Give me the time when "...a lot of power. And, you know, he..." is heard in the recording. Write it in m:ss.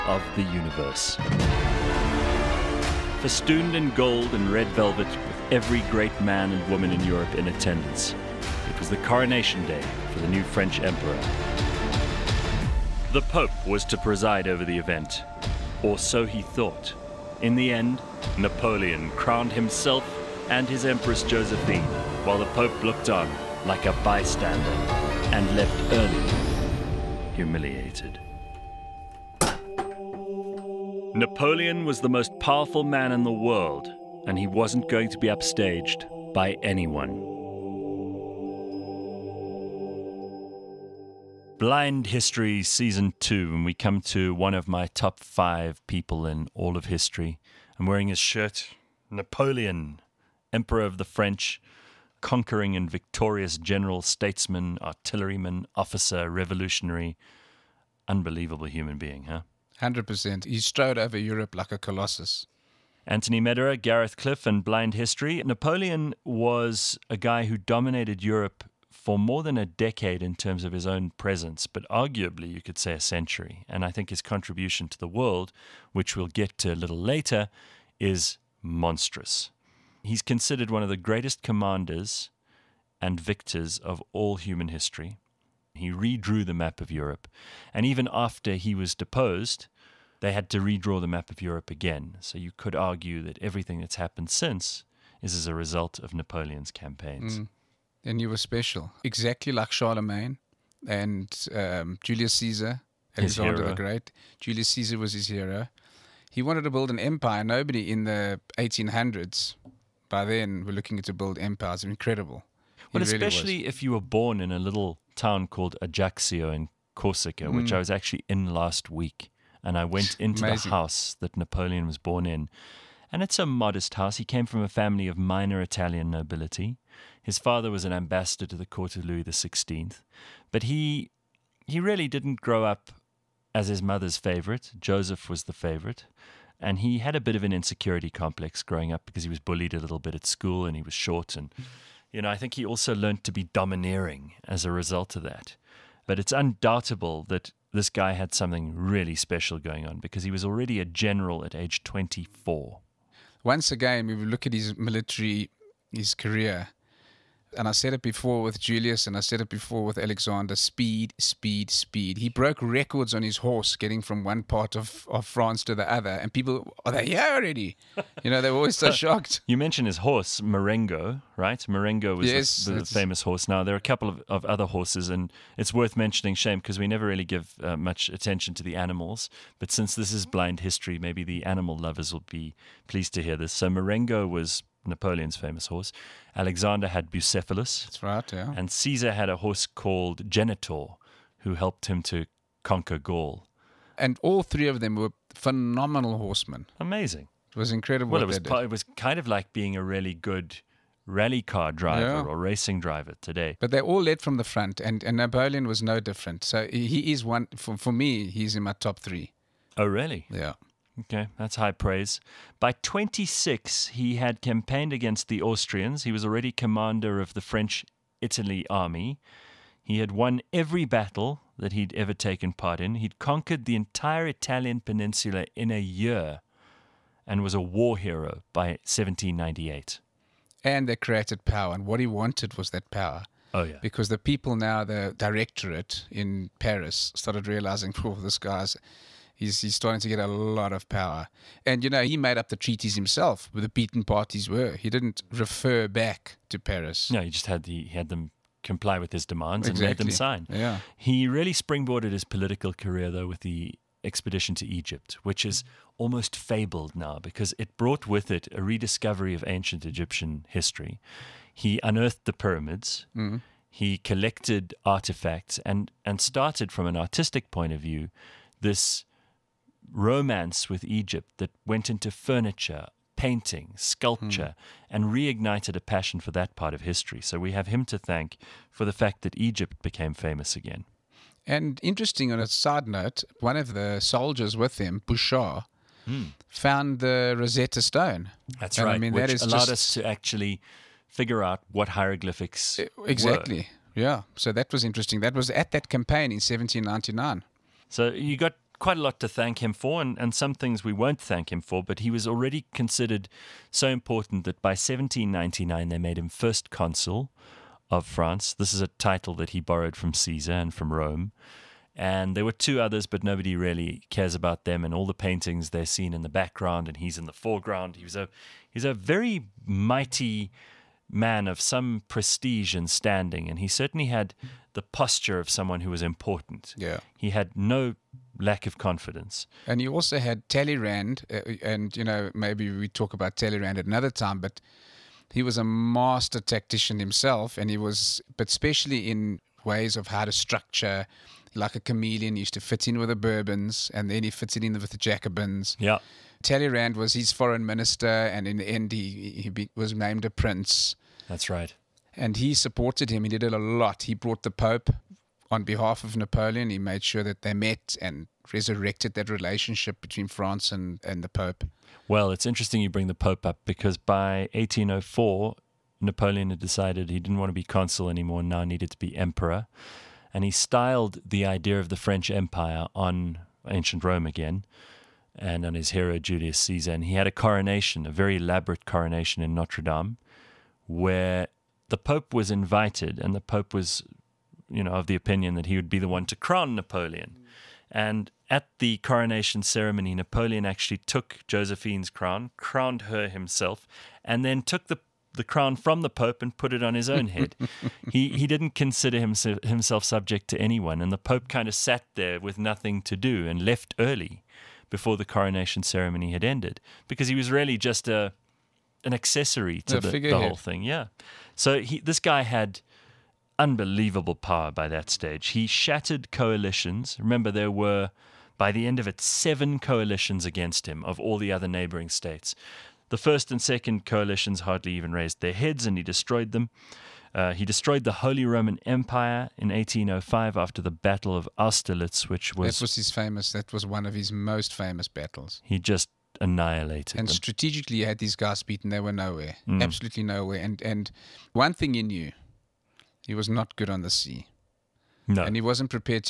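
4:00.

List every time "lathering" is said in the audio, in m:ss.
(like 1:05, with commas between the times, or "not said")
not said.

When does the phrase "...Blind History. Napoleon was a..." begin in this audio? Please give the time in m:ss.
1:04.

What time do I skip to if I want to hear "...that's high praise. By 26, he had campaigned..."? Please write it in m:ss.
3:31.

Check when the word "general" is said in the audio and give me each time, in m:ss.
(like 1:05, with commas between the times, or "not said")
0:53, 2:30.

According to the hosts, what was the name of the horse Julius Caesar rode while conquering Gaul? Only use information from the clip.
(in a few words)
Genitor.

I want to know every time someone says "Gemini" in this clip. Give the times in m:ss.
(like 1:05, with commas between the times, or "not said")
not said.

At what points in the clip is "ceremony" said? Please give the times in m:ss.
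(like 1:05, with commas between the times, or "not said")
6:29, 6:45.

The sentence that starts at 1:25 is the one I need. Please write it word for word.
He redrew the map of Europe.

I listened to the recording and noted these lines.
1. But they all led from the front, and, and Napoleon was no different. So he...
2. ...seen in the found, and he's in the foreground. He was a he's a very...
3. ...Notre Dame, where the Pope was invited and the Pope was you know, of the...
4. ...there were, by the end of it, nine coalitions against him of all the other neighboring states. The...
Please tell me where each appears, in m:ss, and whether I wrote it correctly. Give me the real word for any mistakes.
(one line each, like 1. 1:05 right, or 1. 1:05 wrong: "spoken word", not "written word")
1. 3:23 right
2. 5:15 wrong: "background", not "found"
3. 6:19 right
4. 6:57 wrong: "seven", not "nine".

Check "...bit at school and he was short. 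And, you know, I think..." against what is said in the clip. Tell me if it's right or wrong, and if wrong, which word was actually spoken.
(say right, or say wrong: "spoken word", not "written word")
right.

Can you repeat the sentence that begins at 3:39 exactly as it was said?
He had won every battle that he'd ever taken part in.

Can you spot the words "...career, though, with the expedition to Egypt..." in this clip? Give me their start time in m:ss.
4:12.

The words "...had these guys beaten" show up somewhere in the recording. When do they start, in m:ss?
7:18.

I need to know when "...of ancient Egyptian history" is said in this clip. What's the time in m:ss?
4:19.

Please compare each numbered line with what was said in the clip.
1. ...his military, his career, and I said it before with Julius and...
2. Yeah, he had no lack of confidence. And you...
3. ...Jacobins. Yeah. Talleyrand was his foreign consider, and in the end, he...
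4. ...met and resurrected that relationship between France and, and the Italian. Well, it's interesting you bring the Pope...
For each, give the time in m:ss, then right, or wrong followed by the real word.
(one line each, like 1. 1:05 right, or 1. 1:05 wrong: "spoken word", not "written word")
1. 2:34 right
2. 5:26 right
3. 5:44 wrong: "minister", not "consider"
4. 5:57 wrong: "Pope", not "Italian".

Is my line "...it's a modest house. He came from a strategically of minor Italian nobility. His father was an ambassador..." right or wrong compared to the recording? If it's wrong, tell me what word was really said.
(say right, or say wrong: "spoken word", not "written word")
wrong: "family", not "strategically".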